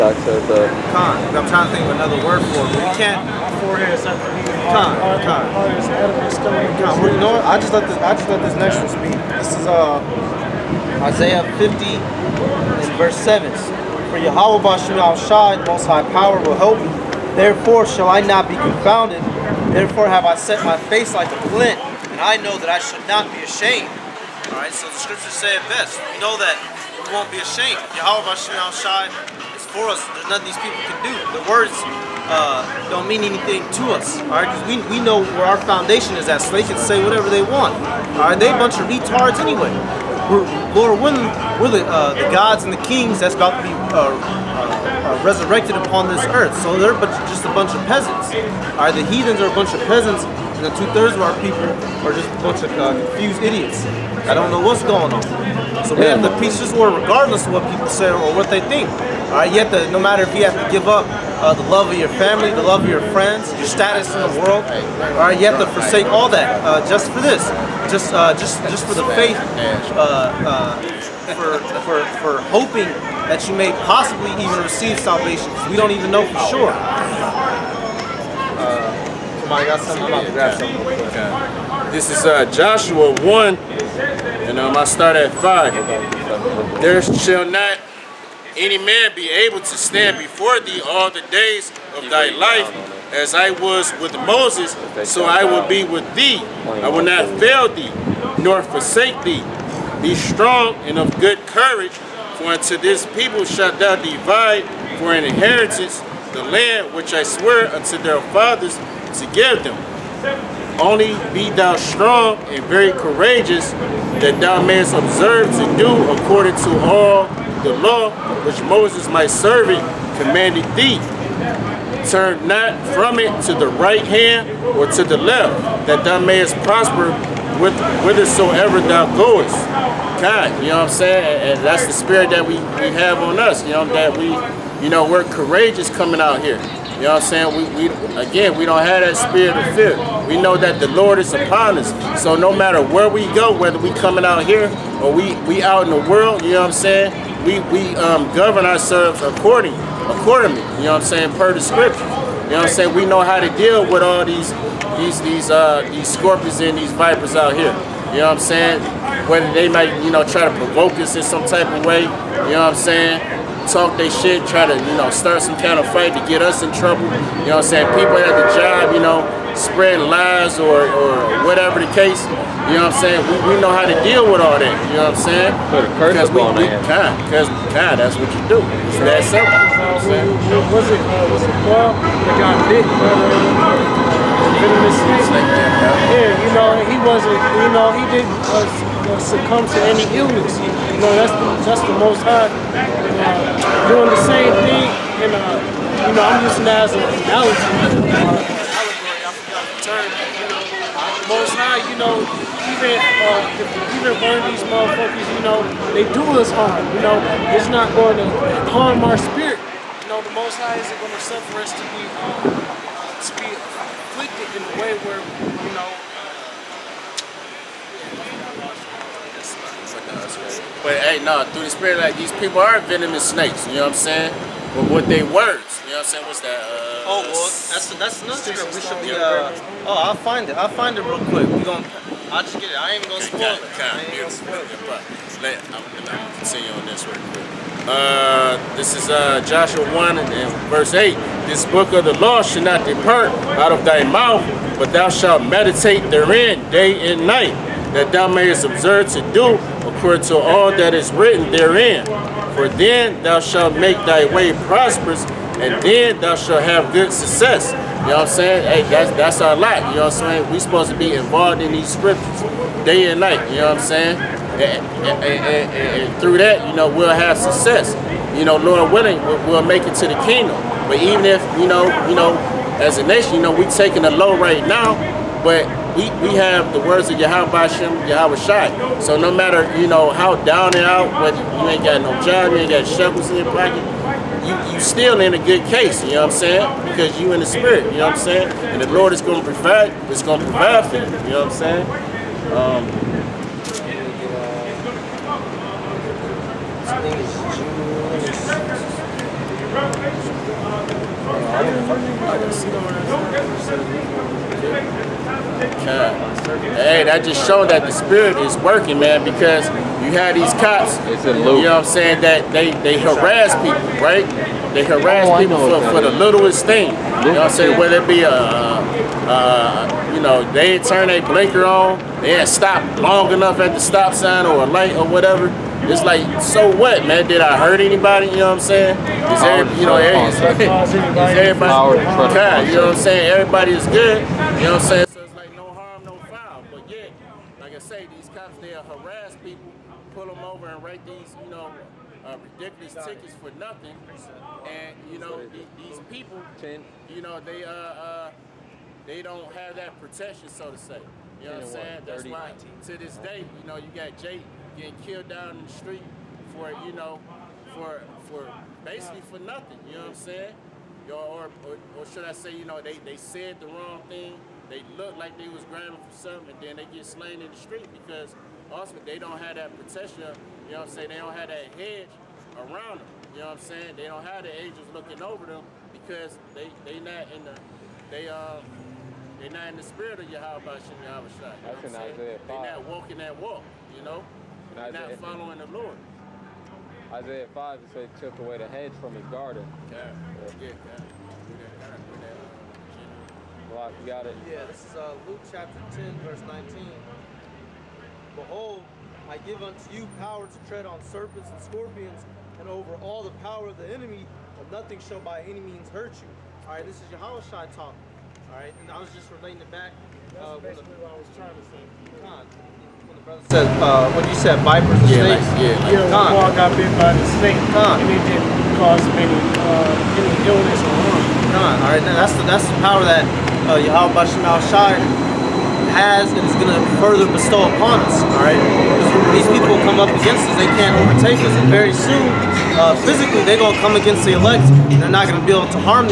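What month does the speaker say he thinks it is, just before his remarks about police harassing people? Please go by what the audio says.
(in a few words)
June.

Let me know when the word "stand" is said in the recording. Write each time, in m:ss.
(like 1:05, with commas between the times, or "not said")
1:29.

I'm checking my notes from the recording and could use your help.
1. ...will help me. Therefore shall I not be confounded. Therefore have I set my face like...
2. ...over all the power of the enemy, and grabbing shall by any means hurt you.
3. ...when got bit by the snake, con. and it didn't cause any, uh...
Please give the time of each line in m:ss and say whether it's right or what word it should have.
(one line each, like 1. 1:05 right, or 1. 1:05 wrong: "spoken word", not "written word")
1. 0:16 right
2. 6:42 wrong: "nothing", not "grabbing"
3. 6:56 right.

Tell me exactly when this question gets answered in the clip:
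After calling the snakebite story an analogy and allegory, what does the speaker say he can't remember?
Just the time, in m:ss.
3:19.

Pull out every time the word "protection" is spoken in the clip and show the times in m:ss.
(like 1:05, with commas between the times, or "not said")
5:50, 6:09.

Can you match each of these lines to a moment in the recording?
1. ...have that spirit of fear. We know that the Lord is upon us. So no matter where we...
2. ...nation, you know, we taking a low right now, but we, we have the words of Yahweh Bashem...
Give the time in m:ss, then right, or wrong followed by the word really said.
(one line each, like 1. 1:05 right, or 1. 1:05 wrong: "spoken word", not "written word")
1. 2:18 right
2. 4:33 right.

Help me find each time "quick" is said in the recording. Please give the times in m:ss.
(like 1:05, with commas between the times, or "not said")
3:51, 3:57.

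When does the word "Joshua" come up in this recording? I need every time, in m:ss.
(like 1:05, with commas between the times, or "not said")
1:22, 3:59.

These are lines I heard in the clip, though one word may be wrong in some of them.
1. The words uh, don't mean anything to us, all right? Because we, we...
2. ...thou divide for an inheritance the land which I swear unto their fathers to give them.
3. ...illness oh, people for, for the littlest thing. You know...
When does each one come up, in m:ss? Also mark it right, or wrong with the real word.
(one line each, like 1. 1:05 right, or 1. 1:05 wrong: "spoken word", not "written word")
1. 0:31 right
2. 1:43 right
3. 5:14 wrong: "harass", not "illness".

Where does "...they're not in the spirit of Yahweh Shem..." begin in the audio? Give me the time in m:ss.
6:19.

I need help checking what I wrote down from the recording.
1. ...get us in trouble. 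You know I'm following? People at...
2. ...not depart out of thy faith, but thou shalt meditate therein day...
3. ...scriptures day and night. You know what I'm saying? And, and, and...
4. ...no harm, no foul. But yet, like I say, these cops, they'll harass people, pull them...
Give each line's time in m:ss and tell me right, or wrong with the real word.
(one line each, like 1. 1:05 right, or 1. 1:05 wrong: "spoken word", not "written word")
1. 2:46 wrong: "saying", not "following"
2. 4:02 wrong: "mouth", not "faith"
3. 4:21 right
4. 5:35 right.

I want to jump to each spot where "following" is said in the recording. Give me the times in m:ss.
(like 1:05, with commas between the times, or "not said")
6:25.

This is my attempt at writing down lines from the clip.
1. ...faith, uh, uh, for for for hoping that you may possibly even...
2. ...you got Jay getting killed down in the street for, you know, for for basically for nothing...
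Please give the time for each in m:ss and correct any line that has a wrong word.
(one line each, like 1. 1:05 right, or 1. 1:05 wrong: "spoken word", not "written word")
1. 1:09 right
2. 5:53 right.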